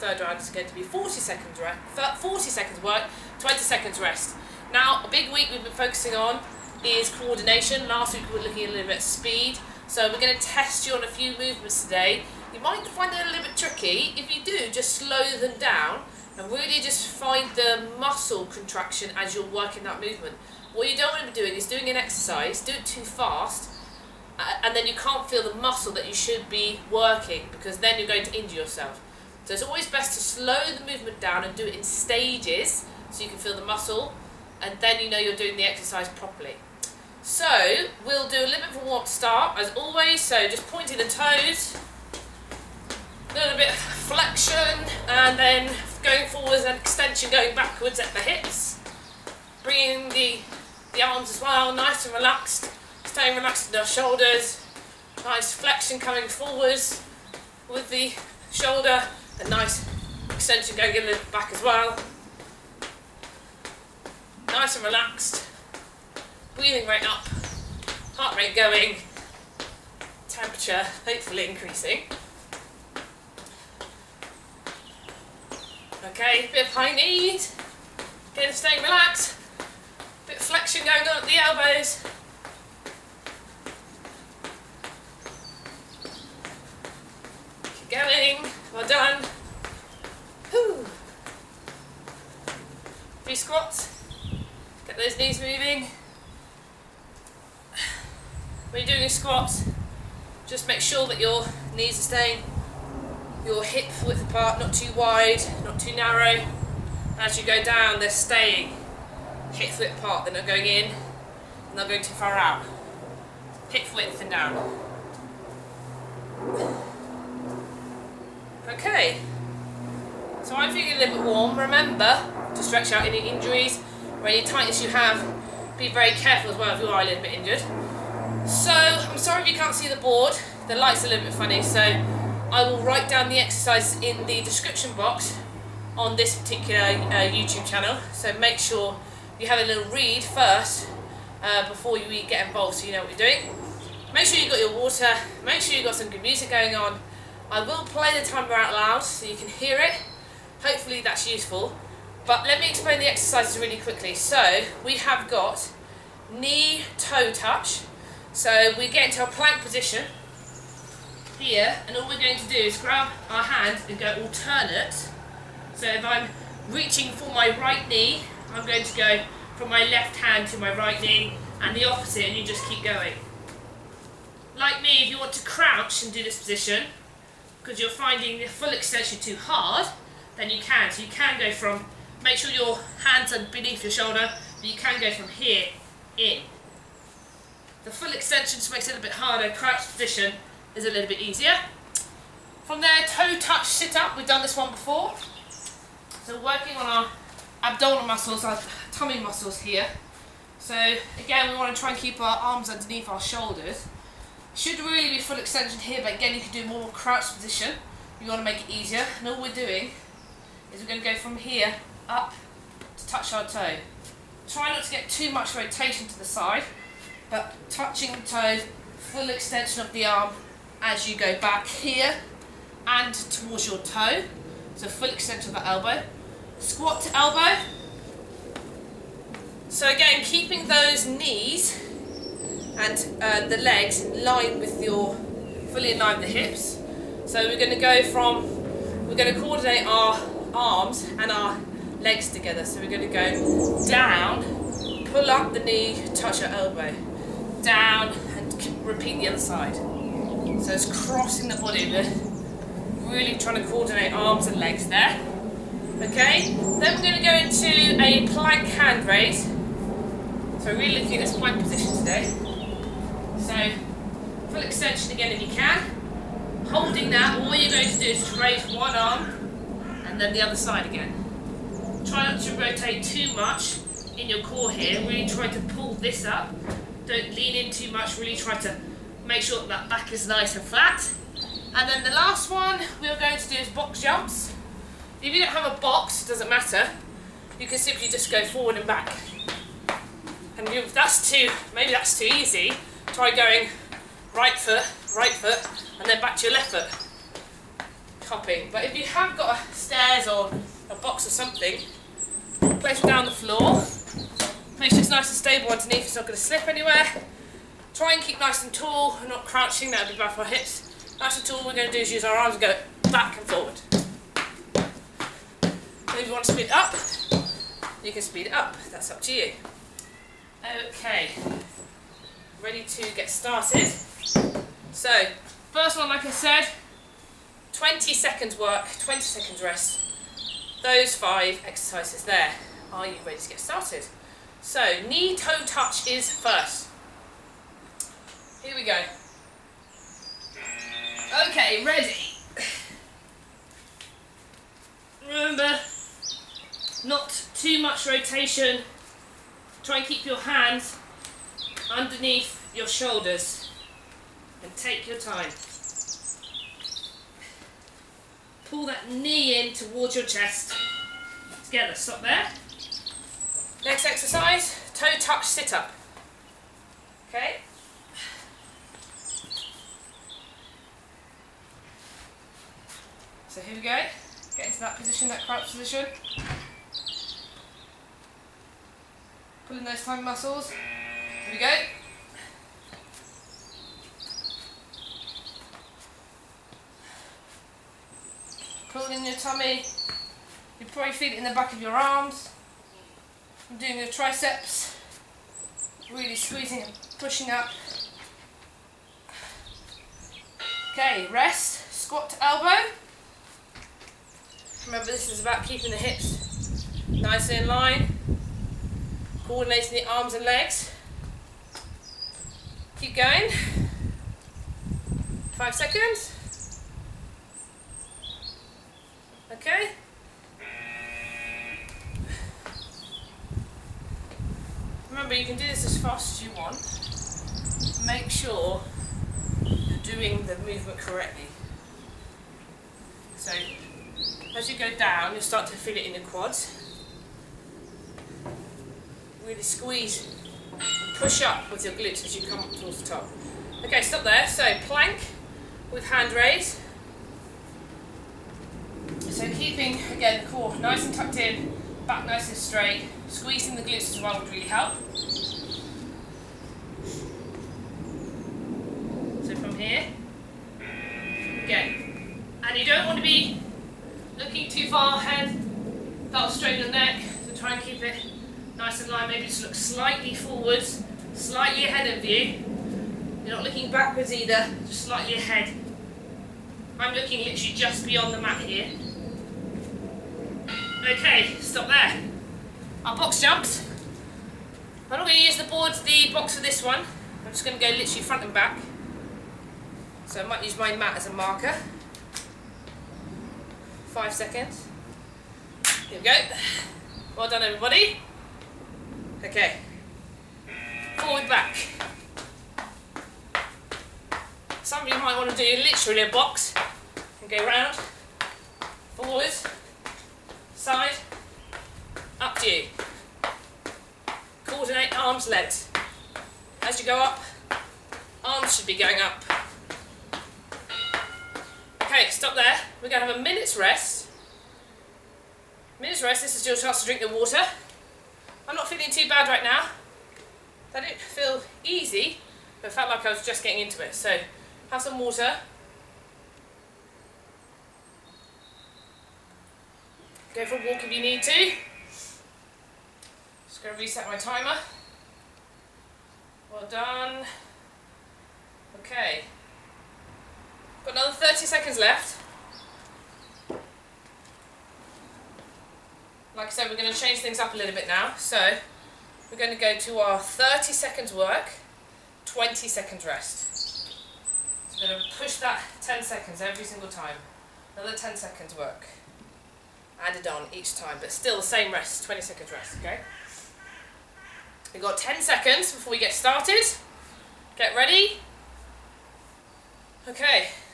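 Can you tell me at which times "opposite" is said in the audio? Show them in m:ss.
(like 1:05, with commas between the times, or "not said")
2:51.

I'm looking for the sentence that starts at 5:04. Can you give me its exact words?
Make sure it's nice and stable underneath, it's not going to slip anywhere.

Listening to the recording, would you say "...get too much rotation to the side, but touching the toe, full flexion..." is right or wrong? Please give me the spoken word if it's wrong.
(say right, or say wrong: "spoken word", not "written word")
wrong: "extension", not "flexion".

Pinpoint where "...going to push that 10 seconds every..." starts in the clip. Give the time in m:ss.
9:25.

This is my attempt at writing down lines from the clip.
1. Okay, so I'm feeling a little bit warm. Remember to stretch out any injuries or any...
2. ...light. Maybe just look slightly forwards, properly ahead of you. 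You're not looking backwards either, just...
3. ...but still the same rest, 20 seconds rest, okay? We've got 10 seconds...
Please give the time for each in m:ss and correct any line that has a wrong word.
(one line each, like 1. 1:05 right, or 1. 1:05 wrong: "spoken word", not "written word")
1. 1:58 right
2. 7:49 wrong: "slightly", not "properly"
3. 9:31 right.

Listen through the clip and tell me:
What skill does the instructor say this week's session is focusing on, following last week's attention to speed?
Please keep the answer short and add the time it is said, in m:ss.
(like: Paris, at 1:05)
Coordination, at 0:07.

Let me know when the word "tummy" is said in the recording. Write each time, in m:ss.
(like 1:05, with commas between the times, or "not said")
3:18, 6:29.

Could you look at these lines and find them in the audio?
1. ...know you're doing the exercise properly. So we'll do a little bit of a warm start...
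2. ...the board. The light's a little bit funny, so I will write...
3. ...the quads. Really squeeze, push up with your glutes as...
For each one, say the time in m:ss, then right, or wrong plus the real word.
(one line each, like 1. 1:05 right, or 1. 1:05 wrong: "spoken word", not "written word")
1. 0:35 right
2. 2:09 right
3. 7:16 right.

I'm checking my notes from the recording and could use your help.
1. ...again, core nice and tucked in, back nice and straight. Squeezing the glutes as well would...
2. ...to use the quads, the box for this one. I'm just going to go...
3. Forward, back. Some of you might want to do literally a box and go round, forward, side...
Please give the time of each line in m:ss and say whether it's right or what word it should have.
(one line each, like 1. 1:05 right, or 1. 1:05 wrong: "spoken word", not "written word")
1. 7:30 right
2. 8:05 wrong: "boards", not "quads"
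3. 8:21 right.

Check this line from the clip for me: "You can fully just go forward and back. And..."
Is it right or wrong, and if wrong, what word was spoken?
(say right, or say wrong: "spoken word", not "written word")
wrong: "simply", not "fully".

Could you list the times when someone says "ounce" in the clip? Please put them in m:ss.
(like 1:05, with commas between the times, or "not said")
not said.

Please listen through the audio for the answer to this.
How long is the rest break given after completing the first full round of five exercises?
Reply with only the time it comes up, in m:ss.
8:43.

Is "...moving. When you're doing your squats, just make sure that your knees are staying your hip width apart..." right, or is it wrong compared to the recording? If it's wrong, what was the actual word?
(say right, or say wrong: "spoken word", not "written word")
right.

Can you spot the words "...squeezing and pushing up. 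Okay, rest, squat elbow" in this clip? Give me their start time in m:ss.
6:36.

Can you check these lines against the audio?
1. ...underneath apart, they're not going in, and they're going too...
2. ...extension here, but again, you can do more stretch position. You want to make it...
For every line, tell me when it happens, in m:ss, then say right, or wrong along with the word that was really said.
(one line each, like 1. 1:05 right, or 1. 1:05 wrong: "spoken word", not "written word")
1. 1:49 wrong: "width", not "underneath"
2. 3:25 wrong: "crouch", not "stretch".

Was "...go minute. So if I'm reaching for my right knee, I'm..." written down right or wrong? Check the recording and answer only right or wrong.
wrong.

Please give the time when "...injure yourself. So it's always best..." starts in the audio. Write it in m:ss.
0:28.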